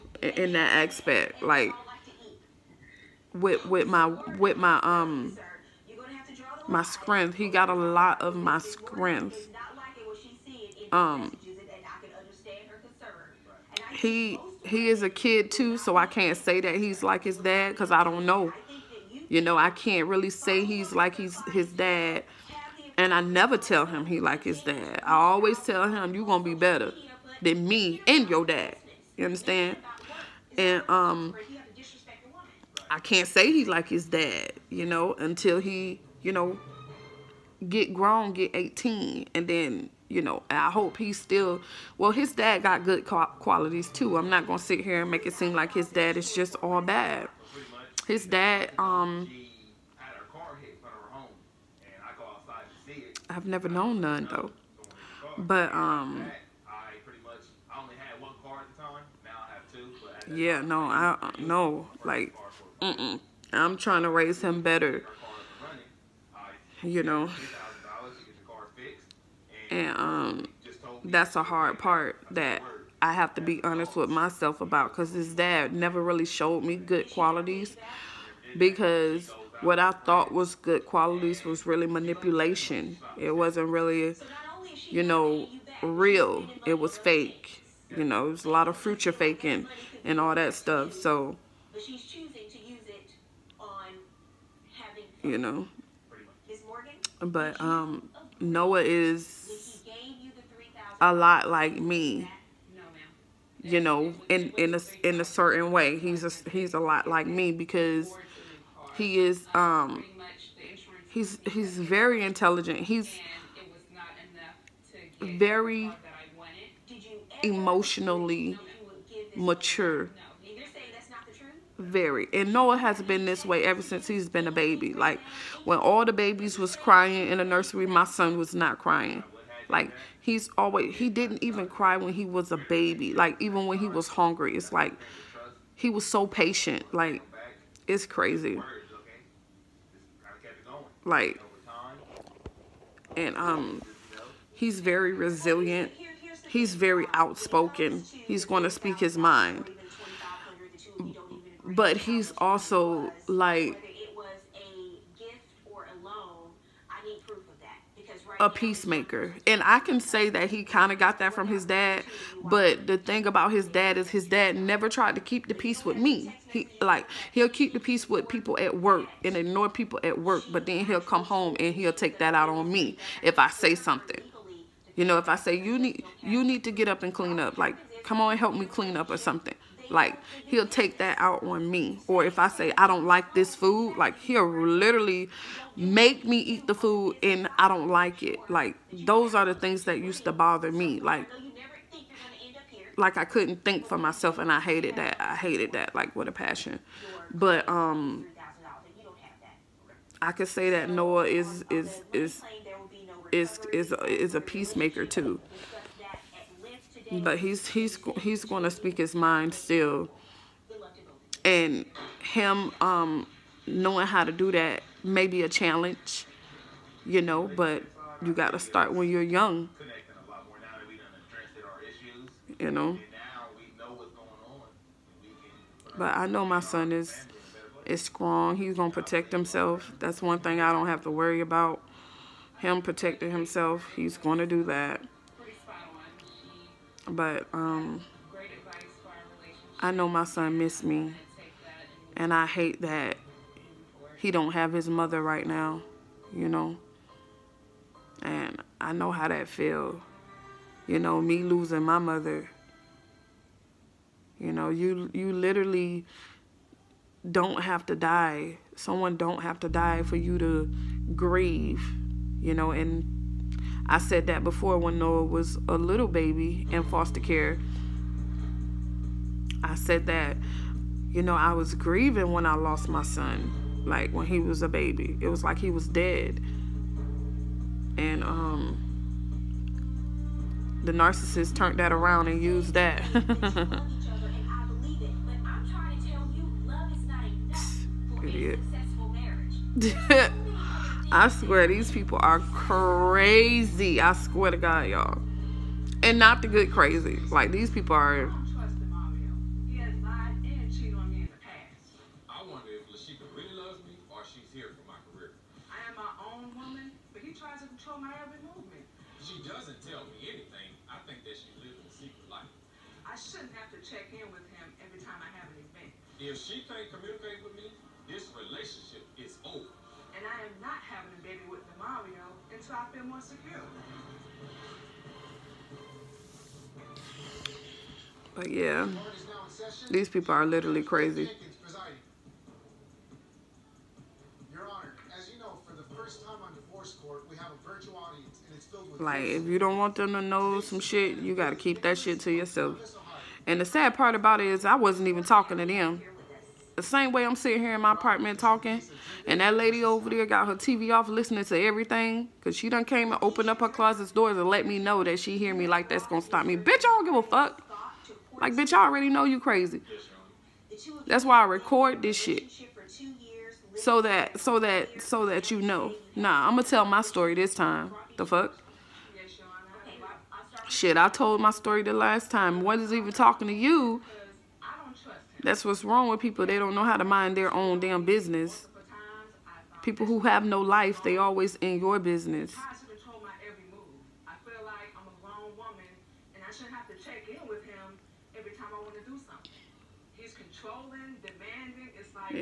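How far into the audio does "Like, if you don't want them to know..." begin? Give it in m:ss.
5:38.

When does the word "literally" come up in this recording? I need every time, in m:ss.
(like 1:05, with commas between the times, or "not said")
3:04, 4:15, 5:30.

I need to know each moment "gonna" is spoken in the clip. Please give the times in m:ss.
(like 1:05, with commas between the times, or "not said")
0:26, 3:48, 3:54, 6:06.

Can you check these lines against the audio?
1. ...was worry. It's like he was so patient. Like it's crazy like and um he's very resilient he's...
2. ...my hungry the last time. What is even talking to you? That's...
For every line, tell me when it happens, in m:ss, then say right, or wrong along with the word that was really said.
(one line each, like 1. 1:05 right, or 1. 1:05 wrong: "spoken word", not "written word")
1. 2:13 wrong: "hungry", not "worry"
2. 6:11 wrong: "story", not "hungry".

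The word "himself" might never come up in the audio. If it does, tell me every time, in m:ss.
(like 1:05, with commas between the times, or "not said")
3:49, 3:53.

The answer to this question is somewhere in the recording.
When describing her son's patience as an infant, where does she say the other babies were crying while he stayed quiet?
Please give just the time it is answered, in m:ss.
2:07.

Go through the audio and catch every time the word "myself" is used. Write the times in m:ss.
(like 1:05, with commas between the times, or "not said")
1:14, 3:13.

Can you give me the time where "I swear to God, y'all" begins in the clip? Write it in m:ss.
4:53.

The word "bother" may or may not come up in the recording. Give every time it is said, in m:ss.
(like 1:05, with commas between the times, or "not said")
3:10.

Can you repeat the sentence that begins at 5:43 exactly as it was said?
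And the sad part about it is I wasn't even talking to them.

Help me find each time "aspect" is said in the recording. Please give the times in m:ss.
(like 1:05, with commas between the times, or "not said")
0:00.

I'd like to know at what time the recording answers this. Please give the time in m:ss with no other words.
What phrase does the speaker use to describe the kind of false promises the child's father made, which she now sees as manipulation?
1:28.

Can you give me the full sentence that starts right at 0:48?
His dad, um, I've never known none though.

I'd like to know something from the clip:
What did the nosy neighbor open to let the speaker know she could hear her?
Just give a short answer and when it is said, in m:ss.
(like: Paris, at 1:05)
closet doors, at 5:53.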